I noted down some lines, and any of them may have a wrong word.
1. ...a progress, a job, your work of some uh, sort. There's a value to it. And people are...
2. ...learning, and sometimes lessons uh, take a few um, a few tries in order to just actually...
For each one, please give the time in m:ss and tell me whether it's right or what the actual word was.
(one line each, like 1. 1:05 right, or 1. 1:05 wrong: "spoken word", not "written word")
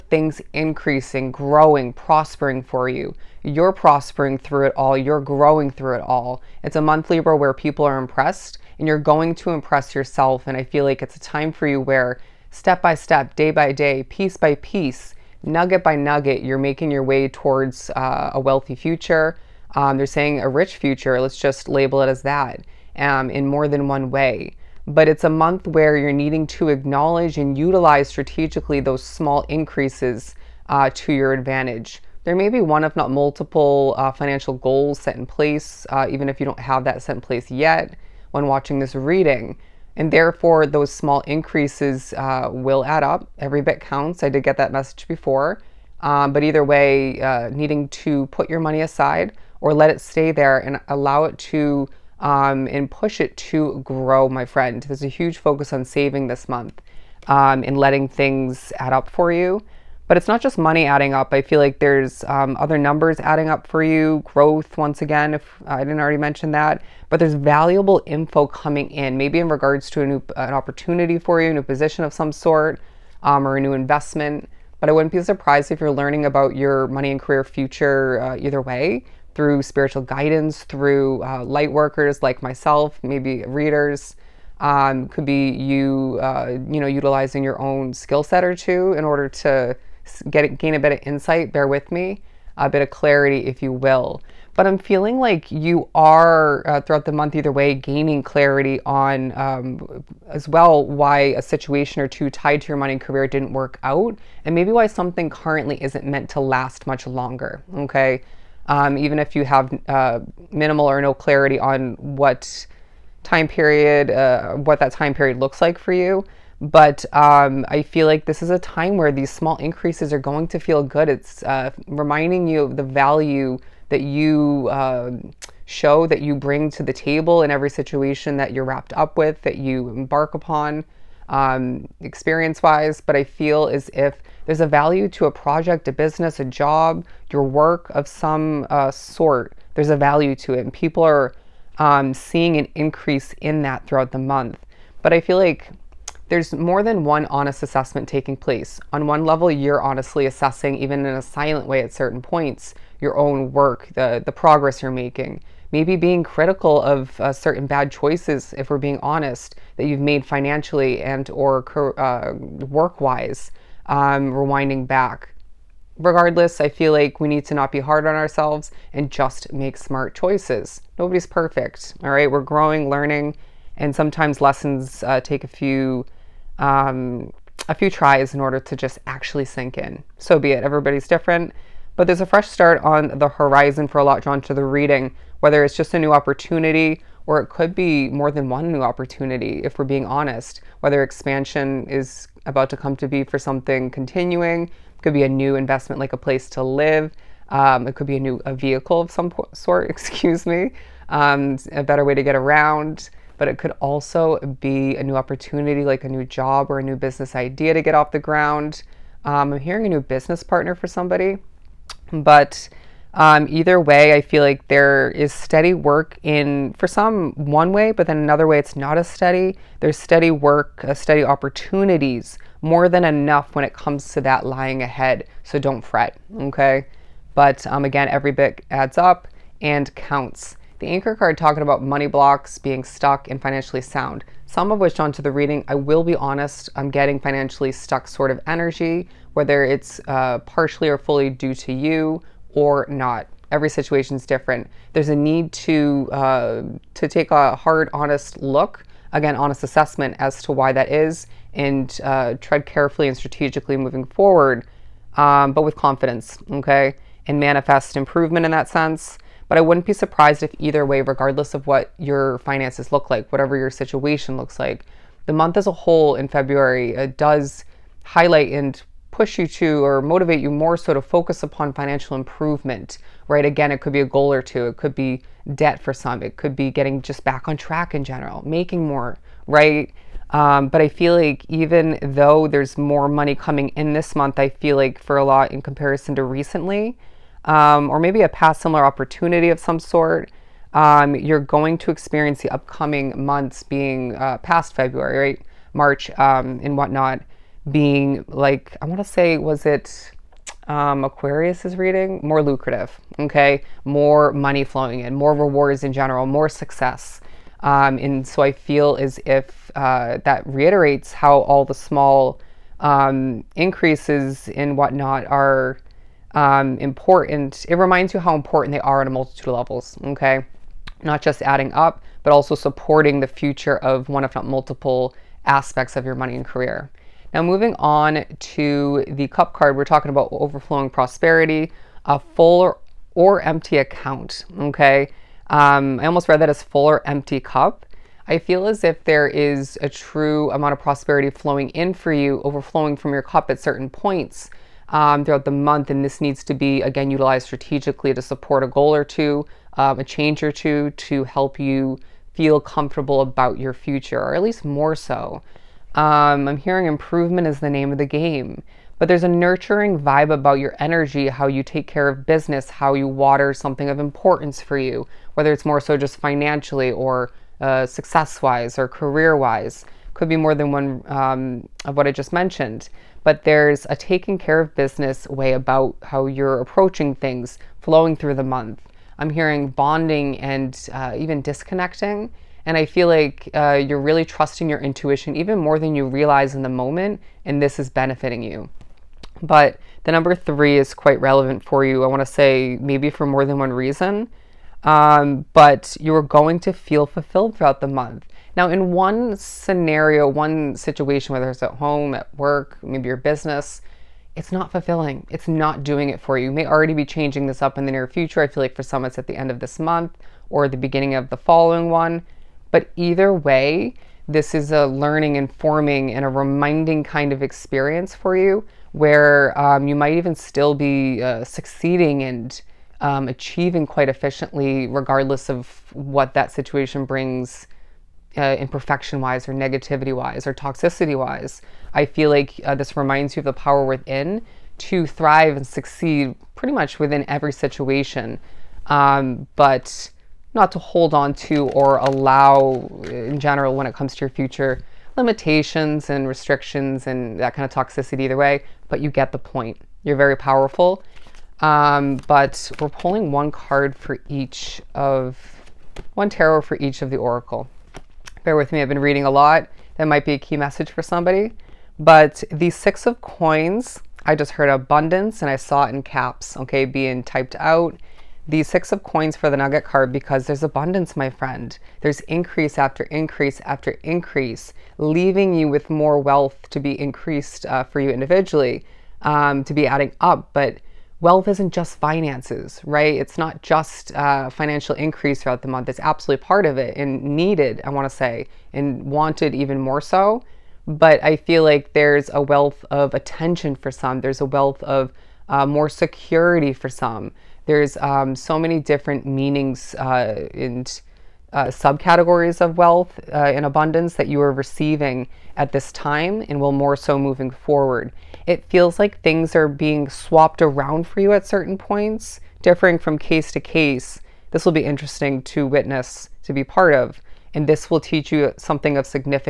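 1. 2:15 wrong: "business", not "progress"
2. 2:52 right.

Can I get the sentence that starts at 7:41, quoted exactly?
But the Six of Coins, I just heard abundance and I saw it in caps, okay, being typed out.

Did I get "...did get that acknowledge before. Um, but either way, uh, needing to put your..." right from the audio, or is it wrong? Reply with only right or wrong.
wrong.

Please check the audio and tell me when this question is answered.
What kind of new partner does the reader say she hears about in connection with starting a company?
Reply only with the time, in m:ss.
3:29.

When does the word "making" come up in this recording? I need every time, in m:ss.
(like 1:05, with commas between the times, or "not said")
0:16, 2:34, 4:38.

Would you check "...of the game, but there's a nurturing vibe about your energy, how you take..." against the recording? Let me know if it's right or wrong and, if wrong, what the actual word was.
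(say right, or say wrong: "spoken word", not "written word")
right.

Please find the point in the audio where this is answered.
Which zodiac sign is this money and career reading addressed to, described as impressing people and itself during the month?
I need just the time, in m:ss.
0:07.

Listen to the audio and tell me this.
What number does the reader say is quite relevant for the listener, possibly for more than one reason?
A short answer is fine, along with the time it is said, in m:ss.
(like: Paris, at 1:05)
3, at 6:30.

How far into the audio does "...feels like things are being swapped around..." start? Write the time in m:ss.
8:28.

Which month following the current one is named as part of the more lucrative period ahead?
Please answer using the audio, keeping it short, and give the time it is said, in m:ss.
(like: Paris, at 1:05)
March, at 4:55.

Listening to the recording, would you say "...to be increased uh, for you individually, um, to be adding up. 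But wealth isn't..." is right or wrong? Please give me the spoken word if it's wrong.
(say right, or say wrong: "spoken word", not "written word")
right.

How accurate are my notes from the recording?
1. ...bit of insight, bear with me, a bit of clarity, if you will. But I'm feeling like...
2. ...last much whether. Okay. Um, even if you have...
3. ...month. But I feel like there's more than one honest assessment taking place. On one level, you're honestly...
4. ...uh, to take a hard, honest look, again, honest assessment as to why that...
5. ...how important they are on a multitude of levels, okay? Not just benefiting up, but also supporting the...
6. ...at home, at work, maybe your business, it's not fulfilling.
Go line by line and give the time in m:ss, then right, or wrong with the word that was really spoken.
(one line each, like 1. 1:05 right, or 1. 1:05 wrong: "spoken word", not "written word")
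1. 1:30 right
2. 1:46 wrong: "longer", not "whether"
3. 2:24 right
4. 4:06 right
5. 5:18 wrong: "adding", not "benefiting"
6. 6:41 right.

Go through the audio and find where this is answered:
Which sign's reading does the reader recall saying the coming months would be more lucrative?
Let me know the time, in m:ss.
5:01.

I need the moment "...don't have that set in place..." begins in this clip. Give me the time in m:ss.
0:36.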